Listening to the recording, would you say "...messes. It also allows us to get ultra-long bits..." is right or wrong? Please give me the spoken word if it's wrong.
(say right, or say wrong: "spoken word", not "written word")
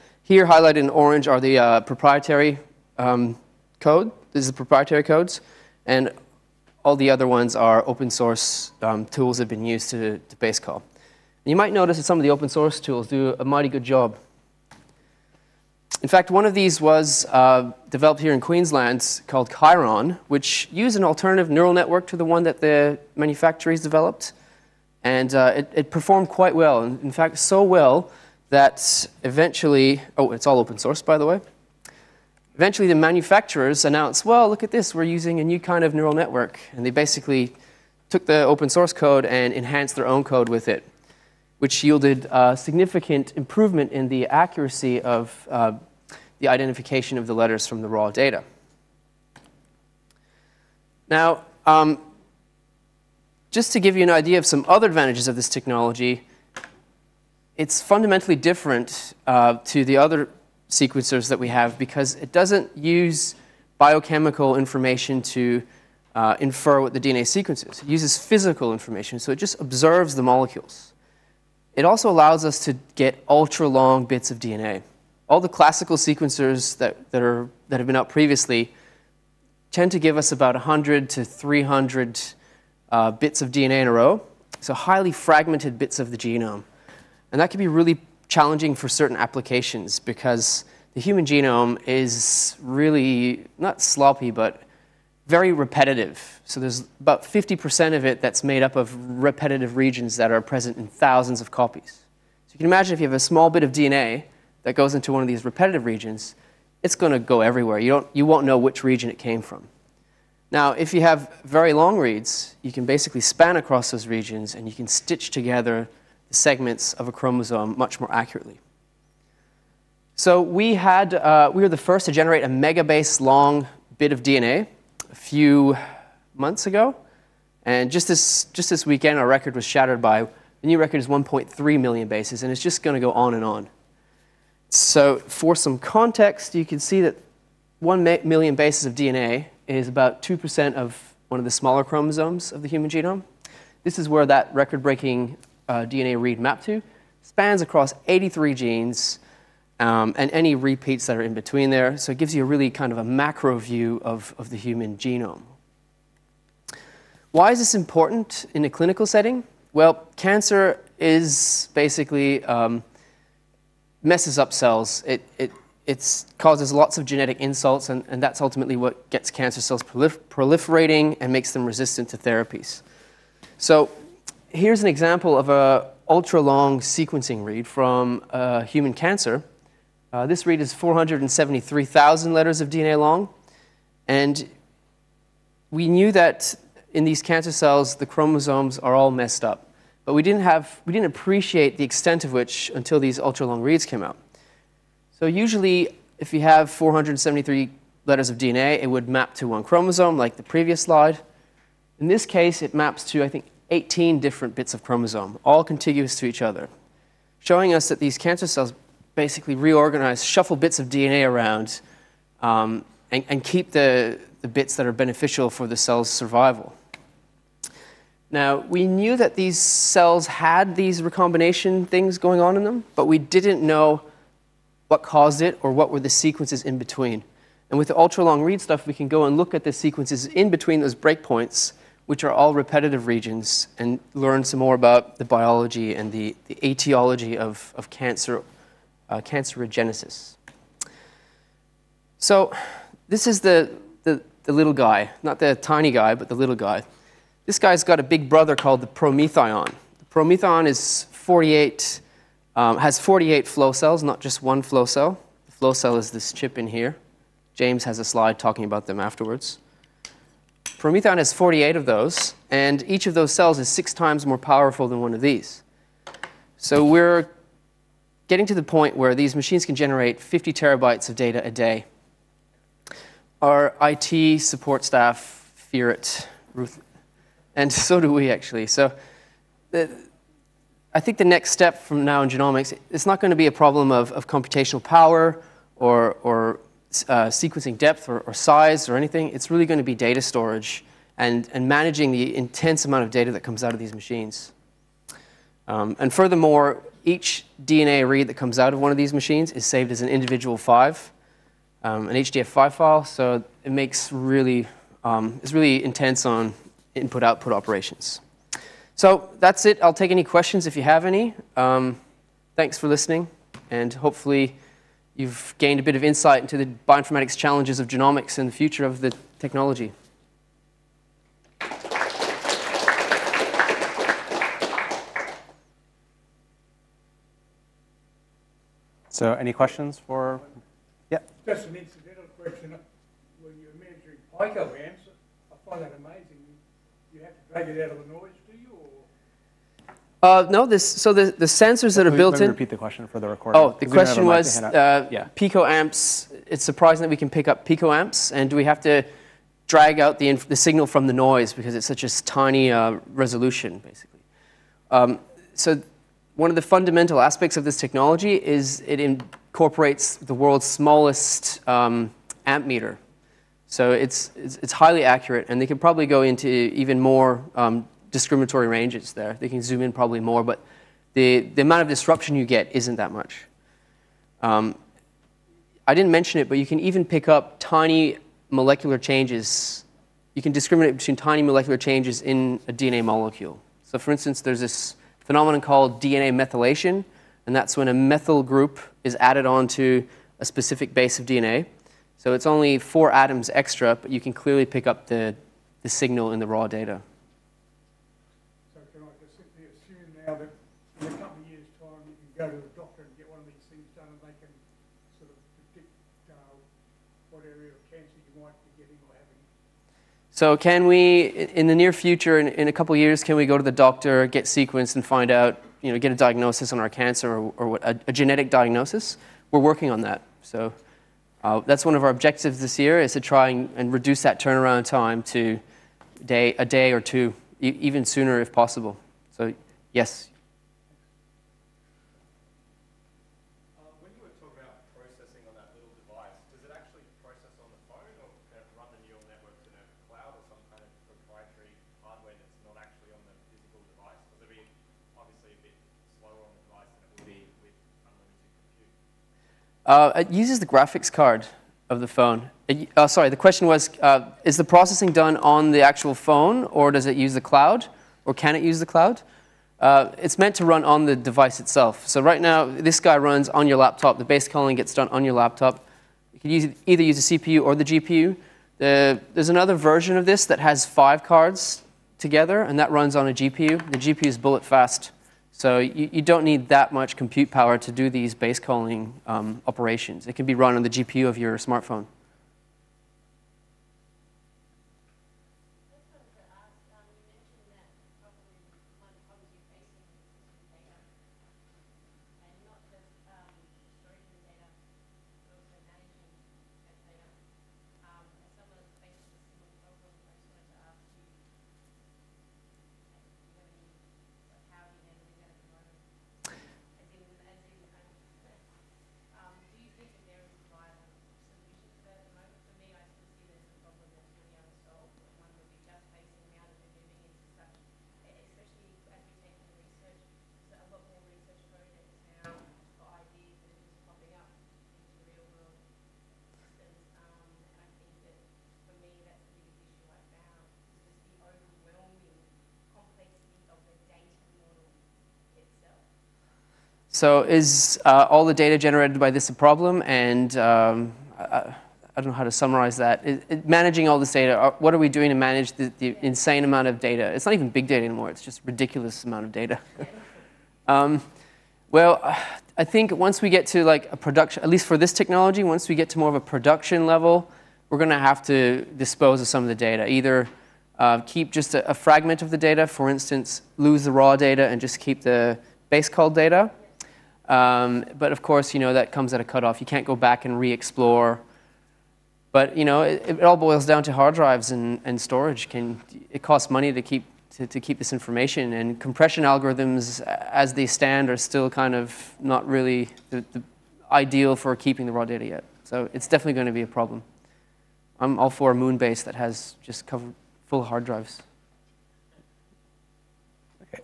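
wrong: "molecules", not "messes".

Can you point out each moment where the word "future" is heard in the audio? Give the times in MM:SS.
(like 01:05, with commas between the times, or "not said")
05:18, 06:51.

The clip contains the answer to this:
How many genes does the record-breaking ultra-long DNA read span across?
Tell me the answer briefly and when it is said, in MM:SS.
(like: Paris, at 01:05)
83, at 02:28.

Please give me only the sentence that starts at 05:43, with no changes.
Oh, the question was uh, yeah.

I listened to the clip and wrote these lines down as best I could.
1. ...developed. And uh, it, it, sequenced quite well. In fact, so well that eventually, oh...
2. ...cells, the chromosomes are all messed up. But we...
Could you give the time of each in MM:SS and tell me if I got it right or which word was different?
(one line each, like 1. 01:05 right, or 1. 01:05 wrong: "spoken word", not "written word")
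1. 00:23 wrong: "performed", not "sequenced"
2. 03:07 right.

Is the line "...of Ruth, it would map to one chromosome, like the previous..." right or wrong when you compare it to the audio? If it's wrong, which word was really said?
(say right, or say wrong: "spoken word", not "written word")
wrong: "DNA", not "Ruth".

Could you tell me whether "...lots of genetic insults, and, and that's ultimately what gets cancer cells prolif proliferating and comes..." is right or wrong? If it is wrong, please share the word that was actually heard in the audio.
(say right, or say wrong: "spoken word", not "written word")
wrong: "makes", not "comes".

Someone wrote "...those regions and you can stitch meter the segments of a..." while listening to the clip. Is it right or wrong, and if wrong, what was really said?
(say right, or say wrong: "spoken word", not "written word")
wrong: "together", not "meter".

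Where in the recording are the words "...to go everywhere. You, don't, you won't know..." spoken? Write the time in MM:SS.
01:47.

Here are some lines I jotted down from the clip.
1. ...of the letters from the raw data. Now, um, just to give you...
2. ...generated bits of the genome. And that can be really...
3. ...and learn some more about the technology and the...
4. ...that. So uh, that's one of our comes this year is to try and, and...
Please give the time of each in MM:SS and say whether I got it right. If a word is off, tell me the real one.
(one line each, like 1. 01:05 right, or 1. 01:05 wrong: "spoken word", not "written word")
1. 00:47 right
2. 01:25 wrong: "fragmented", not "generated"
3. 03:53 wrong: "biology", not "technology"
4. 07:00 wrong: "objectives", not "comes".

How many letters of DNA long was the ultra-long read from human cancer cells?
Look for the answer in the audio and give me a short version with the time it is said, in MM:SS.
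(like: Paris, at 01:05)
473,000, at 03:00.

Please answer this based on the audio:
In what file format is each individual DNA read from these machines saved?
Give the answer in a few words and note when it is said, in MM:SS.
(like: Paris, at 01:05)
HDF5, at 05:02.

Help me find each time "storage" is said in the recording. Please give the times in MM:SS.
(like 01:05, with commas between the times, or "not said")
04:50, 09:35.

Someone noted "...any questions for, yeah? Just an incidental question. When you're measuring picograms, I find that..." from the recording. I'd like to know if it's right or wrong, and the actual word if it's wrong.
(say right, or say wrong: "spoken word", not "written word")
right.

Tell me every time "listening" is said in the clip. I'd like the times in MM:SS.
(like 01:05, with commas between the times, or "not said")
05:12.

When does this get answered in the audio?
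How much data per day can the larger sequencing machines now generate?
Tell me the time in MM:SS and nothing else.
04:30.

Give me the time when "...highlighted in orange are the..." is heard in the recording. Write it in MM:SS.
00:00.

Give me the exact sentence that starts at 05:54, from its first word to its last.
Um, so one of the fundamental aspects of this technology is it incorporates the world's smallest um, meter.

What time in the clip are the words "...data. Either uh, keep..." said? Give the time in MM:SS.
09:19.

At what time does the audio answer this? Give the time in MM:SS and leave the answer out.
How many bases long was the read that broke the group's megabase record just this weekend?
02:11.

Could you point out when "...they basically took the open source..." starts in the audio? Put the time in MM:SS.
00:36.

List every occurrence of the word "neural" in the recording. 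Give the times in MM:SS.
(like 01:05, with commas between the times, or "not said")
00:21, 00:35.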